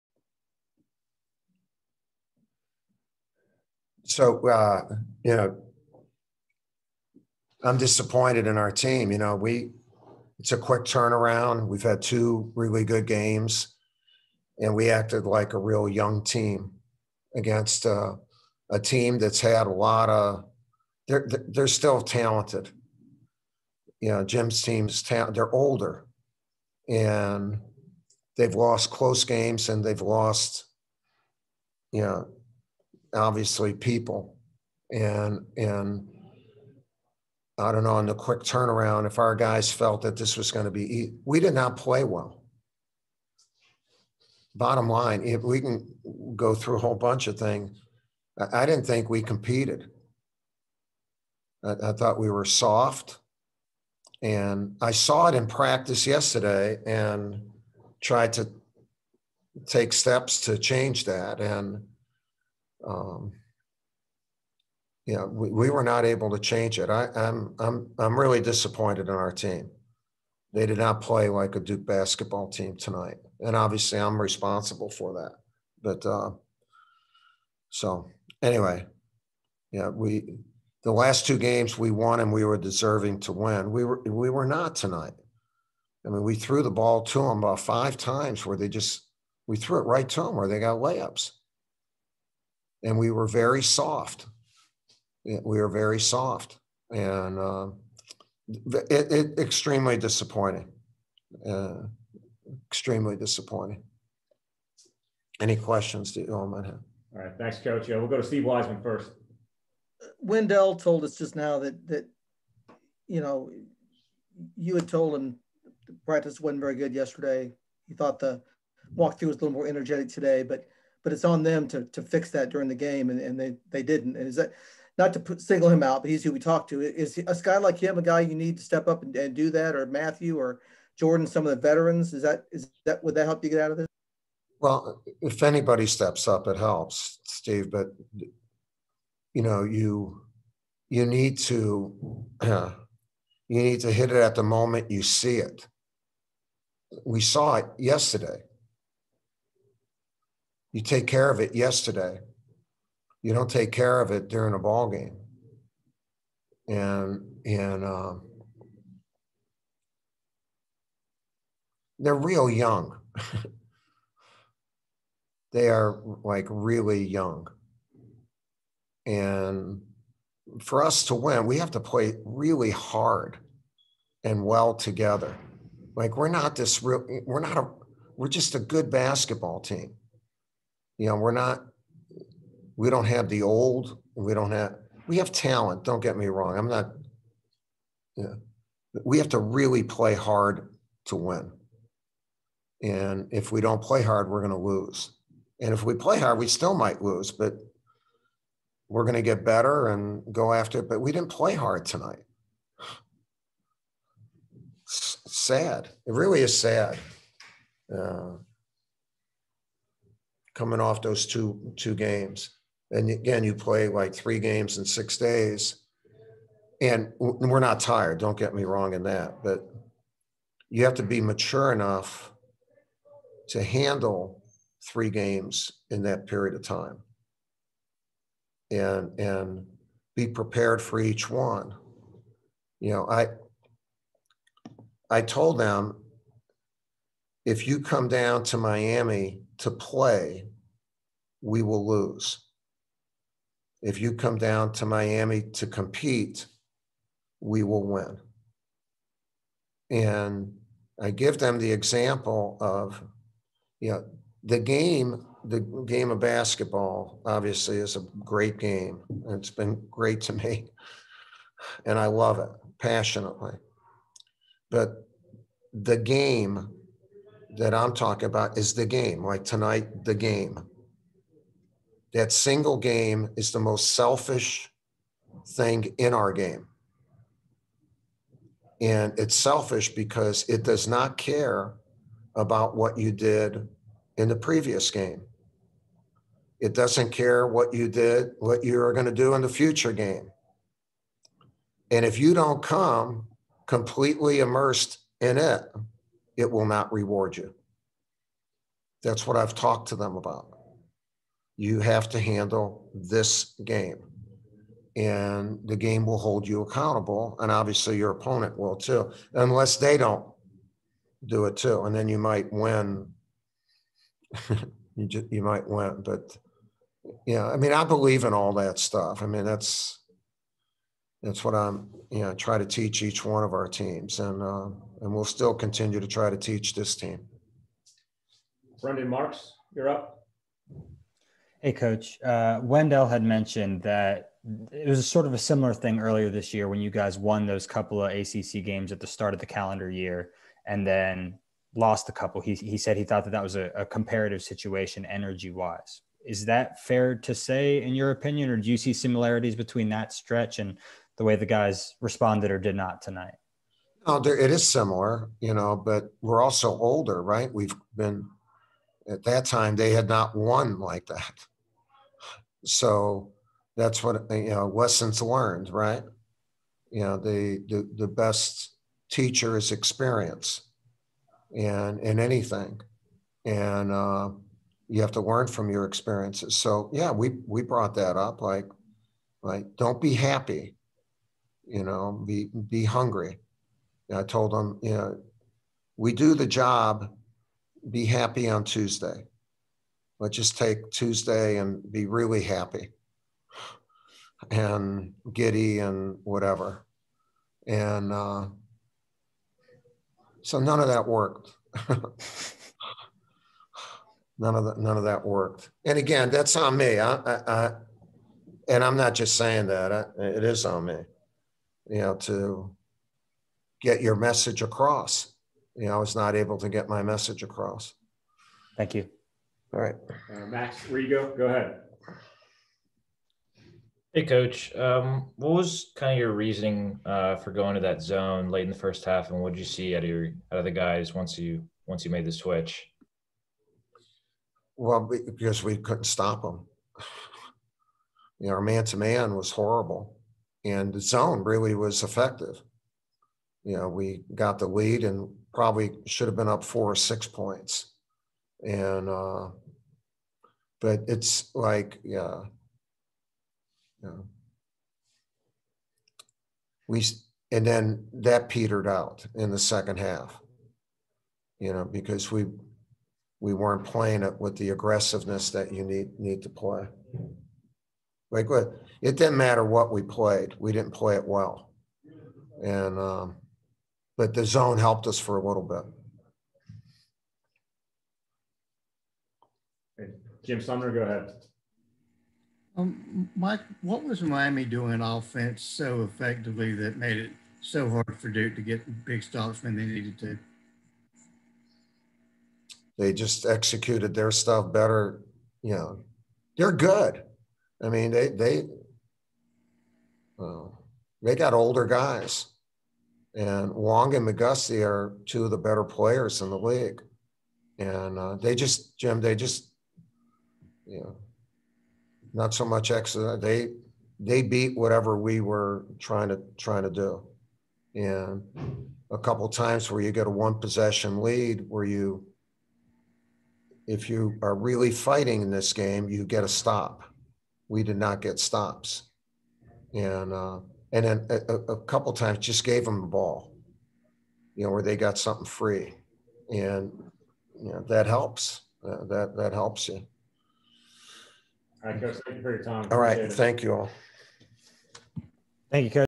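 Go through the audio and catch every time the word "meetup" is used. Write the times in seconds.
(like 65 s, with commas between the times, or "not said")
not said.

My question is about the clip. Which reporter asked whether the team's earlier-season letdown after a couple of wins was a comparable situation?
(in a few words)
Brendan Marks.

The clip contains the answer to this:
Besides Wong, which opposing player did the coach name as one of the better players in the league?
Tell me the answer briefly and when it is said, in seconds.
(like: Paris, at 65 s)
McGusty, at 504 s.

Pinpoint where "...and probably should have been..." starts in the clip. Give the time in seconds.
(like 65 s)
445 s.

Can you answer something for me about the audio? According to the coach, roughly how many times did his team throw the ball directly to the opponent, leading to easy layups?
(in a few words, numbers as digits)
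5.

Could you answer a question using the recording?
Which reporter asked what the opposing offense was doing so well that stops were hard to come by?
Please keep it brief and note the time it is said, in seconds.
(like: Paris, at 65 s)
Jim Sumner, at 480 s.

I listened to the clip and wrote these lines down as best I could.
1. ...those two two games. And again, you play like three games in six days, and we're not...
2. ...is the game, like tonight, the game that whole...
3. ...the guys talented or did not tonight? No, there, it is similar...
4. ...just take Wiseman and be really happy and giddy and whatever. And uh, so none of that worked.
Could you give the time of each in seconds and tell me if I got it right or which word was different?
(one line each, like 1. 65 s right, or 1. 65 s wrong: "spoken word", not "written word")
1. 211 s right
2. 268 s wrong: "single", not "whole"
3. 351 s wrong: "responded", not "talented"
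4. 390 s wrong: "Tuesday", not "Wiseman".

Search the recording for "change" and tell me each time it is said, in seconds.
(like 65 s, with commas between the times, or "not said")
60 s, 66 s.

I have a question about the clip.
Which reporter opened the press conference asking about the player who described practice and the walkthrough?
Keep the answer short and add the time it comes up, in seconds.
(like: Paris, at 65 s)
Steve Wiseman, at 108 s.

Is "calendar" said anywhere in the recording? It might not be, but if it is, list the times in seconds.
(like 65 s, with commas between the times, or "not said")
339 s.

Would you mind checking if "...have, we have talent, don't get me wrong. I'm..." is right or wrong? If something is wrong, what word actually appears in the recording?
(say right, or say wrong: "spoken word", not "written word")
right.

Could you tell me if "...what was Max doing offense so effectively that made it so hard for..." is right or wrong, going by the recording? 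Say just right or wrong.
wrong.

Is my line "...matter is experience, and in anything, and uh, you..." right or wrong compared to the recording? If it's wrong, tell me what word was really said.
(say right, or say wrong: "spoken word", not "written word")
wrong: "teacher", not "matter".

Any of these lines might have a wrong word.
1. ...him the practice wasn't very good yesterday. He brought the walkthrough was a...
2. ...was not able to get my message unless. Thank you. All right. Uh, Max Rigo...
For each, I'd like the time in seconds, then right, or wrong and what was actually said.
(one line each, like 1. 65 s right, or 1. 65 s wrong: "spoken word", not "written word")
1. 115 s wrong: "thought", not "brought"
2. 415 s wrong: "across", not "unless".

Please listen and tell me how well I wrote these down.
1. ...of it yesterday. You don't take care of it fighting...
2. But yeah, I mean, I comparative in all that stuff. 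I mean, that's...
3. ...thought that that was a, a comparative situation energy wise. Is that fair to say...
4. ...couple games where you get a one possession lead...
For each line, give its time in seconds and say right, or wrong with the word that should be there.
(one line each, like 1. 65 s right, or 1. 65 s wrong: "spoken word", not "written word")
1. 151 s wrong: "during", not "fighting"
2. 316 s wrong: "believe", not "comparative"
3. 343 s right
4. 519 s wrong: "times", not "games".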